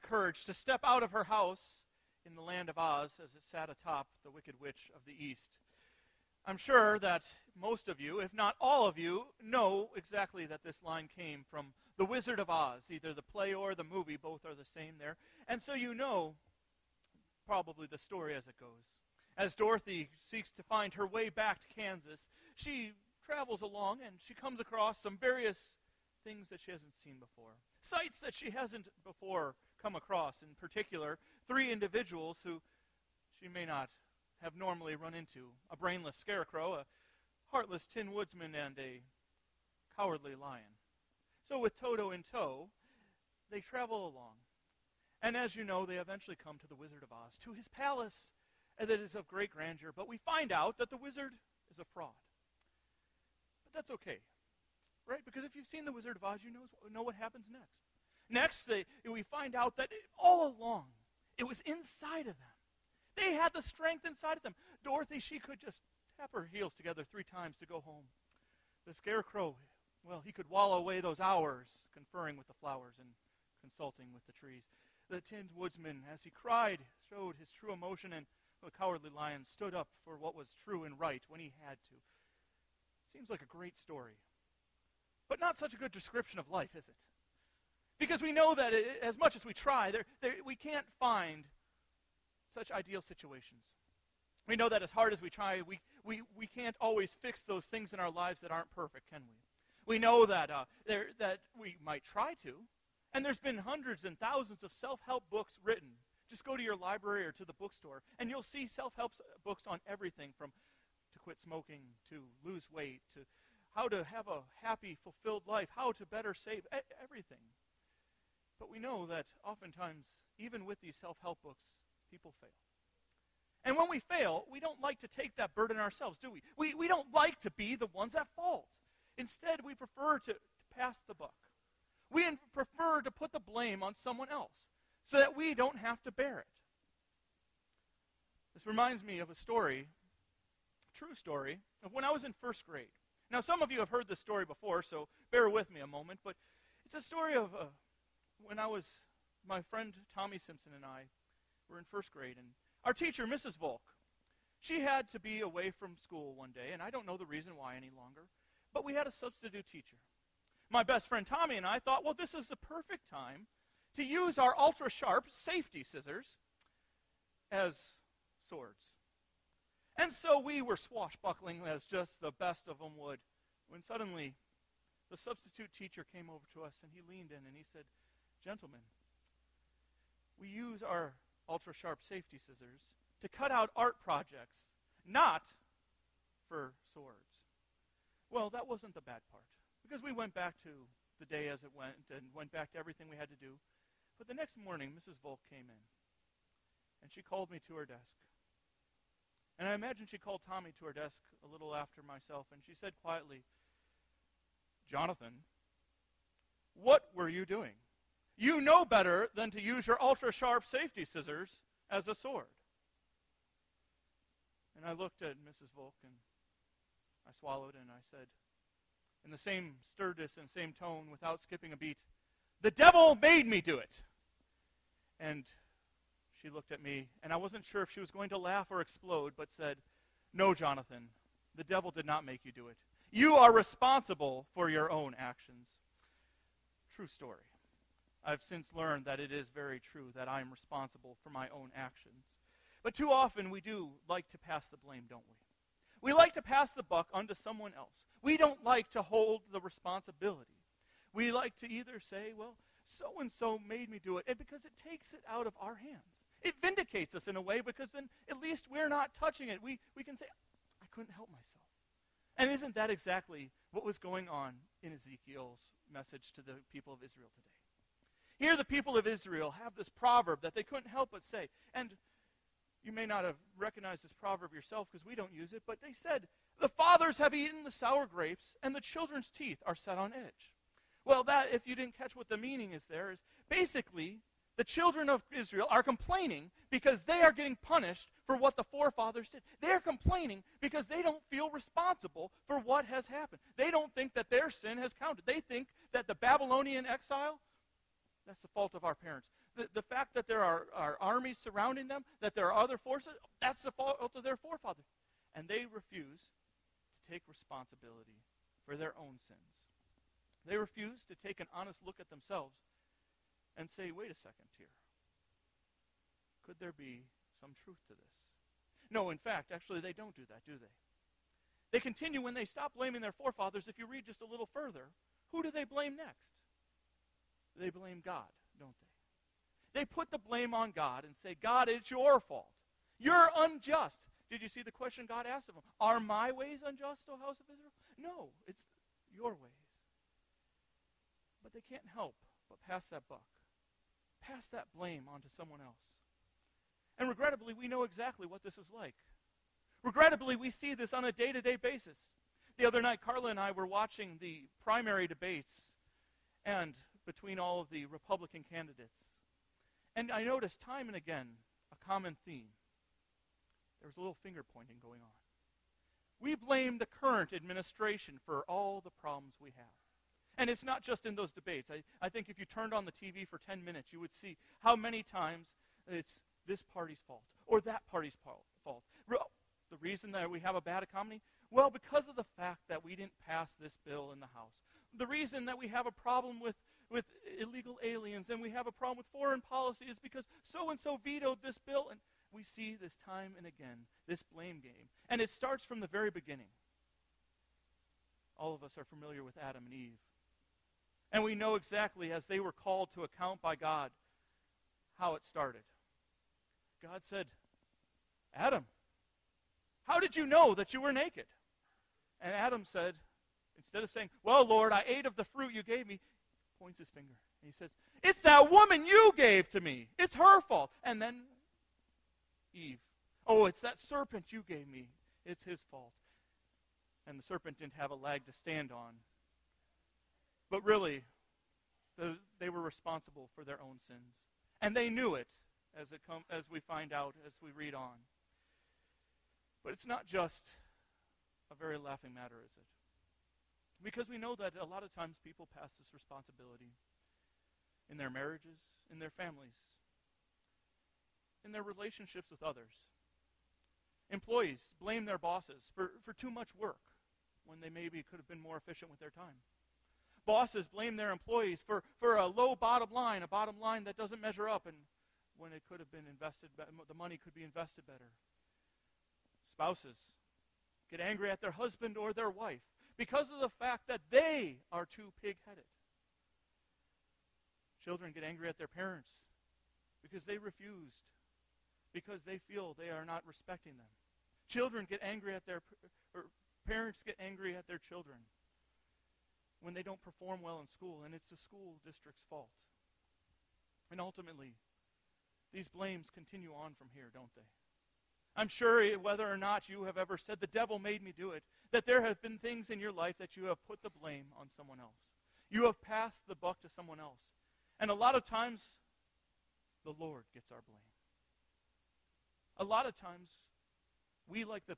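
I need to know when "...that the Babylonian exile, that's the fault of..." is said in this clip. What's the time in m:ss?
4:55.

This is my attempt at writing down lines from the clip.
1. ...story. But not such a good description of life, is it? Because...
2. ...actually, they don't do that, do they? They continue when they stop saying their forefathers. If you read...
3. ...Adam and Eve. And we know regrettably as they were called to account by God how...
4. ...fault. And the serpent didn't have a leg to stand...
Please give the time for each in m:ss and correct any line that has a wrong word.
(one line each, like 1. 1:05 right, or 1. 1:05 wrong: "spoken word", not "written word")
1. 1:23 right
2. 5:19 wrong: "blaming", not "saying"
3. 6:39 wrong: "exactly", not "regrettably"
4. 7:05 right.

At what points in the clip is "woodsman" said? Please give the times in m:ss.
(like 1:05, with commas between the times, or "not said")
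0:38, 1:15.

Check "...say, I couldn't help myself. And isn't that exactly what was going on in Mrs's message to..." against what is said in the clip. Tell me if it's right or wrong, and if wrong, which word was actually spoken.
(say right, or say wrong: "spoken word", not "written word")
wrong: "Ezekiel", not "Mrs".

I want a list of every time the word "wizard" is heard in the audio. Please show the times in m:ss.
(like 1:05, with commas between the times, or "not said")
0:12, 0:46, 0:50, 0:55.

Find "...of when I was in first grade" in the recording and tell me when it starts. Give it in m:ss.
2:21.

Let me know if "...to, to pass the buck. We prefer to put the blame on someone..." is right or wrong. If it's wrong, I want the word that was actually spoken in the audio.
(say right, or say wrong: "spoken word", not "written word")
right.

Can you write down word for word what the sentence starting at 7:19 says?
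But it's not just a very laughing matter, is it?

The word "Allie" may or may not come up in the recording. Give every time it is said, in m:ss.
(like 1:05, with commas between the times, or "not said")
not said.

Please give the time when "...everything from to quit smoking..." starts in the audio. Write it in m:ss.
1:49.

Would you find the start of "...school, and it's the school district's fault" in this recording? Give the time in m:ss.
8:10.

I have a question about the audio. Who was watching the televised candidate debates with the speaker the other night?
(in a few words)
Carla.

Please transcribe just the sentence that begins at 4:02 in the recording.
But too often we do like to pass the blame, don't we?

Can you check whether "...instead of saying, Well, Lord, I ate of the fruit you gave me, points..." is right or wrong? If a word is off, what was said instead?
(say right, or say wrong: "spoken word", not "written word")
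right.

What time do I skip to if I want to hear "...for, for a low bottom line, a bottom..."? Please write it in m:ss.
7:41.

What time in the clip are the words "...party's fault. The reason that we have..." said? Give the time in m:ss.
6:17.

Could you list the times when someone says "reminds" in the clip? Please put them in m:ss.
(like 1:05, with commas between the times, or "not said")
2:18.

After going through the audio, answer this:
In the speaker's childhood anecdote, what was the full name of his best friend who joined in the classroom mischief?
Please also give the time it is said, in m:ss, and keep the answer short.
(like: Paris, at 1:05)
Tommy Simpson, at 2:30.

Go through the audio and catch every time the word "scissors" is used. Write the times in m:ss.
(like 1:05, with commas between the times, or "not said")
2:45, 3:02, 3:31.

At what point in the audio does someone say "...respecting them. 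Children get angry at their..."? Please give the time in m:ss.
8:03.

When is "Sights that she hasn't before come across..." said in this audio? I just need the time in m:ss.
0:27.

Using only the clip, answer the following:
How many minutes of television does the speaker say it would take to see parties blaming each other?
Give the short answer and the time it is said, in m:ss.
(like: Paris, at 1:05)
10, at 6:13.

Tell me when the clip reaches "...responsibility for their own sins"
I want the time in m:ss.
5:07.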